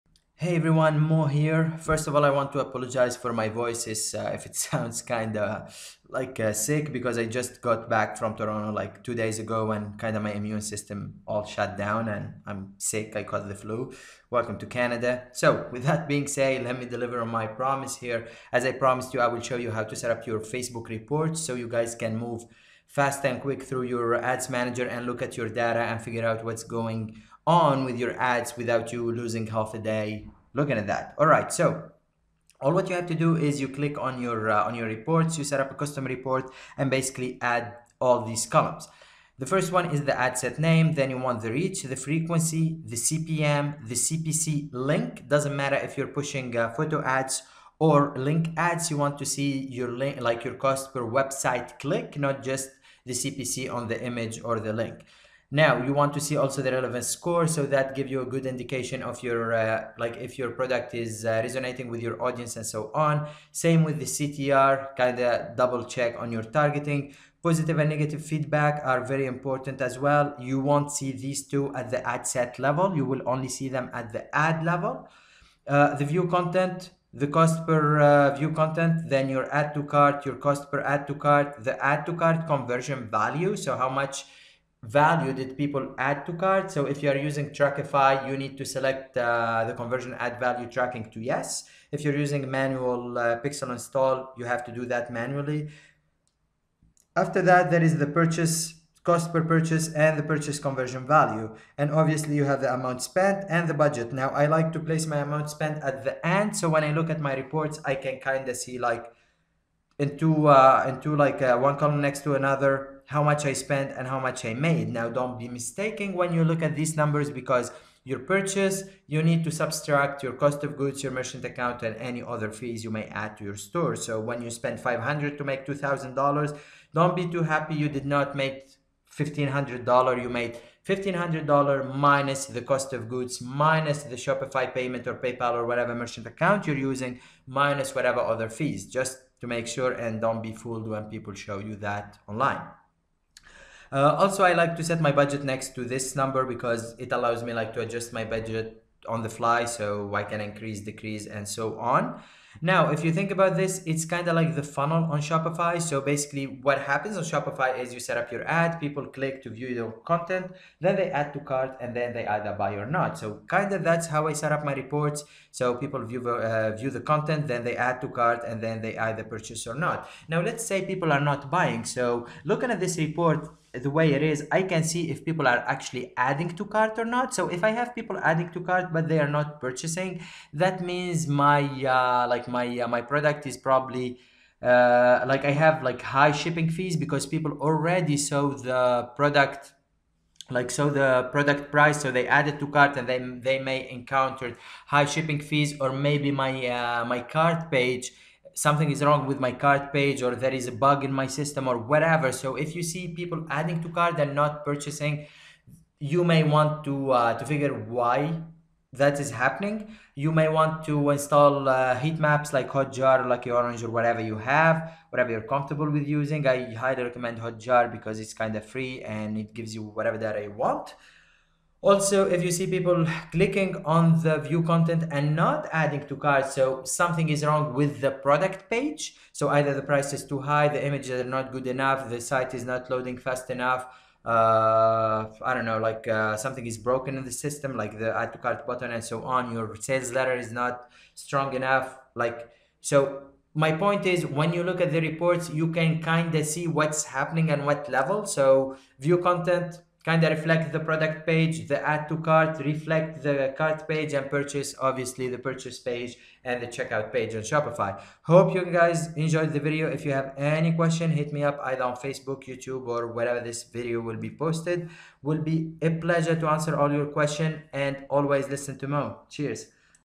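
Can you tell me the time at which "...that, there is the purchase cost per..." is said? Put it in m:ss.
1:37.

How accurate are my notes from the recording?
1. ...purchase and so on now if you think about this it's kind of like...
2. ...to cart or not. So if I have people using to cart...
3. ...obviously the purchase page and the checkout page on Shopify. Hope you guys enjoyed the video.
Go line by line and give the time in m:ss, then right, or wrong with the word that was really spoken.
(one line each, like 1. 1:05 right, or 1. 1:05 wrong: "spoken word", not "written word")
1. 2:30 wrong: "decrease", not "purchase"
2. 2:56 wrong: "adding", not "using"
3. 4:14 right.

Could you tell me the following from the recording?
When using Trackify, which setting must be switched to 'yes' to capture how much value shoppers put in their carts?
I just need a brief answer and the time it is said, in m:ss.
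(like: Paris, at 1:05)
conversion add value tracking, at 1:29.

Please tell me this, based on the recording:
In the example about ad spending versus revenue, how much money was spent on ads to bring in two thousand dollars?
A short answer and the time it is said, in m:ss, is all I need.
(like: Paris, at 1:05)
500, at 2:04.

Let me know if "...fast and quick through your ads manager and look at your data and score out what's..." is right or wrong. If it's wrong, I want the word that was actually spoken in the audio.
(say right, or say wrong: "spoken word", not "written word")
wrong: "figure", not "score".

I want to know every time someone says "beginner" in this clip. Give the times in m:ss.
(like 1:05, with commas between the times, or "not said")
not said.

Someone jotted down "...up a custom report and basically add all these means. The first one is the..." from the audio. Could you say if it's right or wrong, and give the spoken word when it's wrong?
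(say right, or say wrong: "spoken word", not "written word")
wrong: "columns", not "means".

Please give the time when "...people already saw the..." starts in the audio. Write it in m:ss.
3:07.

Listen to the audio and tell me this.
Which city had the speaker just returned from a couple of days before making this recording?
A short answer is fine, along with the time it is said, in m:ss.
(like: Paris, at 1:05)
Toronto, at 0:08.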